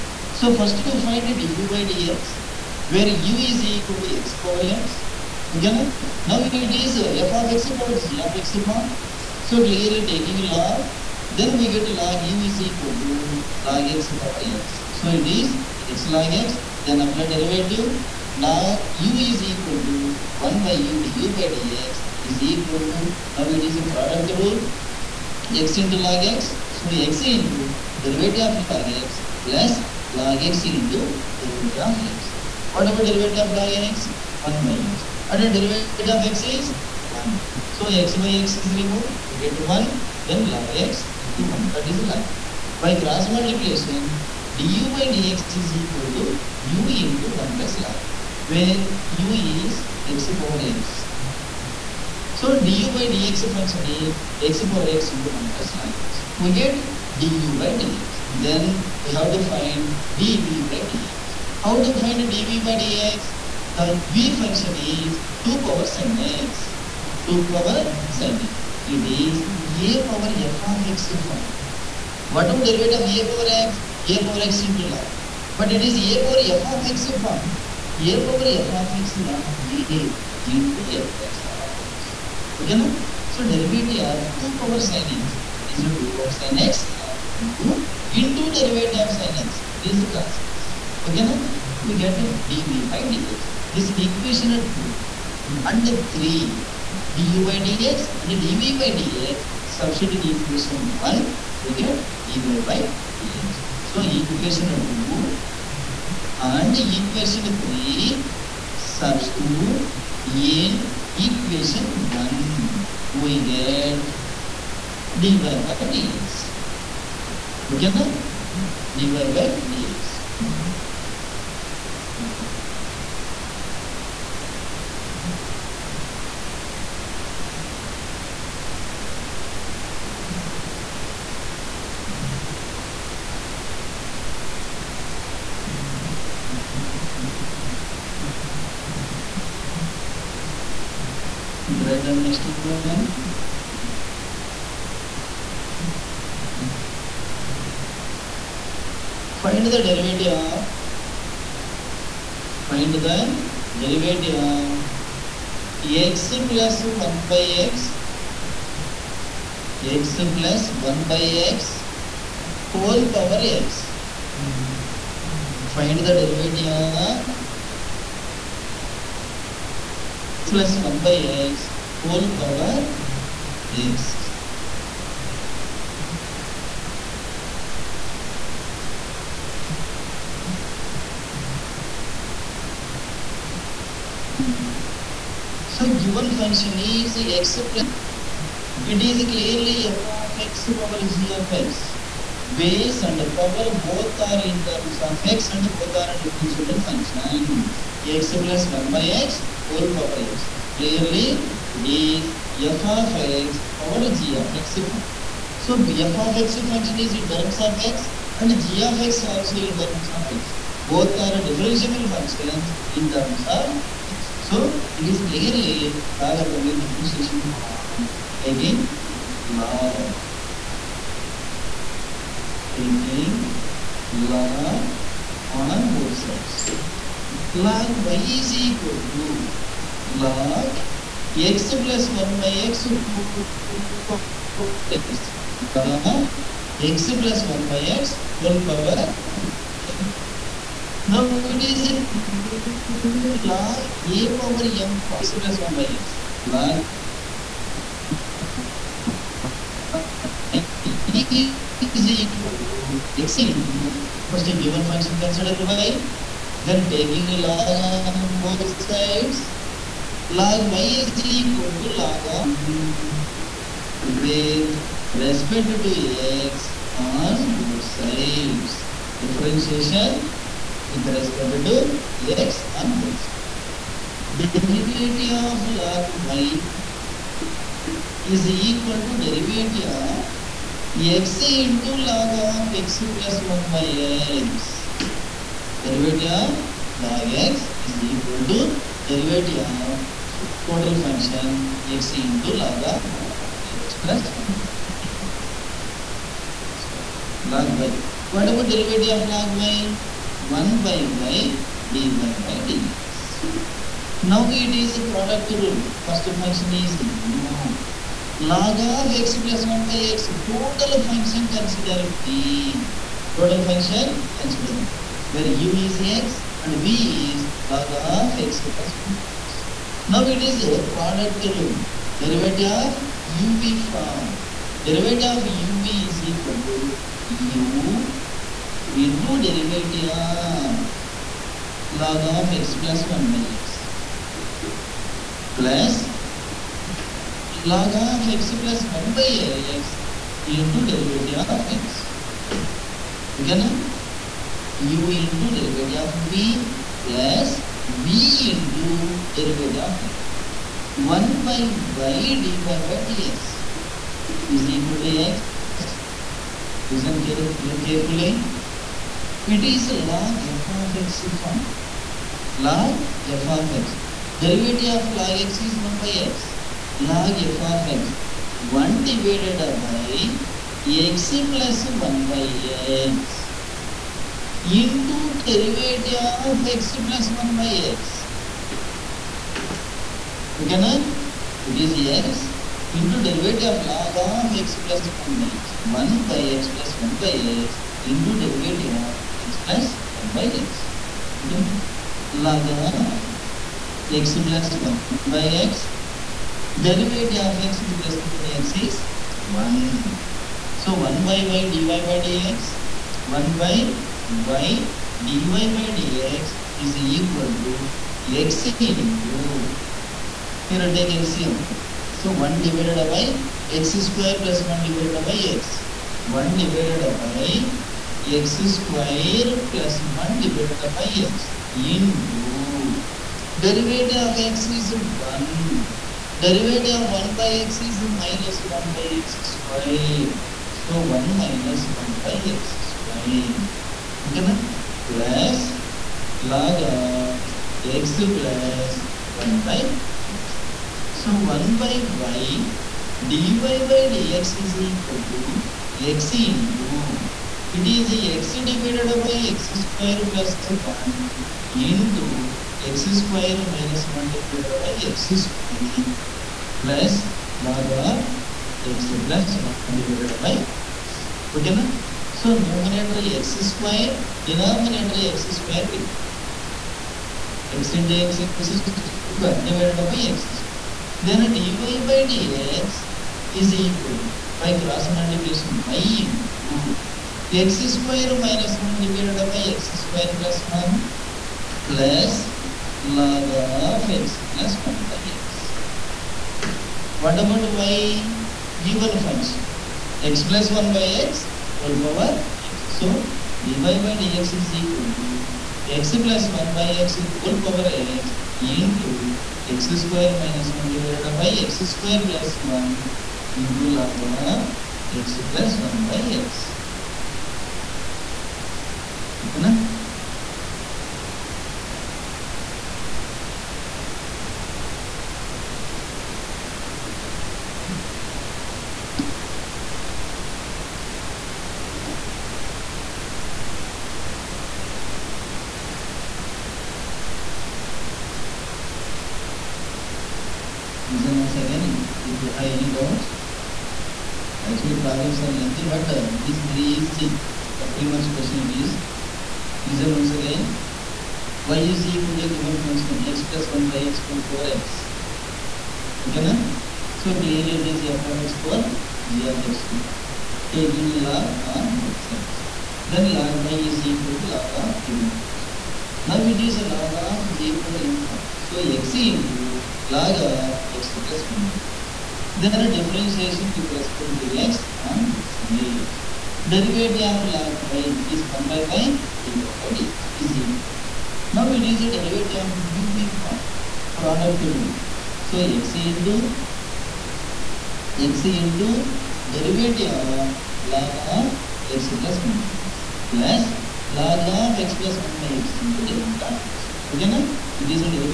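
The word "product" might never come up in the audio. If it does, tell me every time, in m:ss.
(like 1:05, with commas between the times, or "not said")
0:23, 5:05, 5:20, 9:34.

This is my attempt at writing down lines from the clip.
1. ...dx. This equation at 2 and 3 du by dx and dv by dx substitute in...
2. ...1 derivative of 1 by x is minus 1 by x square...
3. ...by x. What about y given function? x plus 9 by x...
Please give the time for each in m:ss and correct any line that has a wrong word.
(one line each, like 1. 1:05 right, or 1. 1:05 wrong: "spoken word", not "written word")
1. 1:33 right
2. 7:04 right
3. 8:05 wrong: "1", not "9".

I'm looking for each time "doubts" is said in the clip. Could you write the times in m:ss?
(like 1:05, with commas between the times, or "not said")
8:52.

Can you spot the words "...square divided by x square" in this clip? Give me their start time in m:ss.
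7:49.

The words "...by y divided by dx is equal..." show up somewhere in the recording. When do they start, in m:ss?
9:28.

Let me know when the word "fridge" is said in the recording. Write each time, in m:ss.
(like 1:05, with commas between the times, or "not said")
not said.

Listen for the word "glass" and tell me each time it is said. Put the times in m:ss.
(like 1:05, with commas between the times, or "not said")
not said.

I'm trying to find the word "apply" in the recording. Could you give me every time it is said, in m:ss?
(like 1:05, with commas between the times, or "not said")
0:17.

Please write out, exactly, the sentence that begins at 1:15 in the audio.
But it is a power f of x form.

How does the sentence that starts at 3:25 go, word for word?
So b f of x function is in terms of x and g of x also in terms of x.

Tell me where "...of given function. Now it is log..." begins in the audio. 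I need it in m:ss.
9:14.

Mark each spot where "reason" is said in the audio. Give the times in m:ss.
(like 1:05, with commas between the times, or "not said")
8:51.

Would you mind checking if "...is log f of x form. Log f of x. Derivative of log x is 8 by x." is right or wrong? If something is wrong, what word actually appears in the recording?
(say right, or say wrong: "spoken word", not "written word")
wrong: "1", not "8".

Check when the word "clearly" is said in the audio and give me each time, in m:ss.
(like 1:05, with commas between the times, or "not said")
0:09, 3:09, 3:20, 3:35, 9:07.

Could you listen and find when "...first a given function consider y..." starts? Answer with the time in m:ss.
4:14.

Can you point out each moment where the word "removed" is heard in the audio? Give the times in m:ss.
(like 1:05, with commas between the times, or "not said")
0:38.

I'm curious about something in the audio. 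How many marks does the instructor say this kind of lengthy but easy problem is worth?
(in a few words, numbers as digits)
3.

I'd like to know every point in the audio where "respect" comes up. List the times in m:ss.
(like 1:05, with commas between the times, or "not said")
4:25, 4:31, 6:38, 9:23.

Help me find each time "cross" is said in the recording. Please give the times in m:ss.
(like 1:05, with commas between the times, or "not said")
0:43, 7:54.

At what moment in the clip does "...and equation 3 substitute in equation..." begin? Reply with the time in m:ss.
1:46.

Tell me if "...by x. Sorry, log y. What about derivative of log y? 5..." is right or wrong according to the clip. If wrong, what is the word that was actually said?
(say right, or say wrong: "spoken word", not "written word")
wrong: "1", not "5".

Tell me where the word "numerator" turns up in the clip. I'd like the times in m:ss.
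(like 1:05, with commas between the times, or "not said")
7:42.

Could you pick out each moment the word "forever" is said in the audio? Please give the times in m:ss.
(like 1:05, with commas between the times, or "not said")
not said.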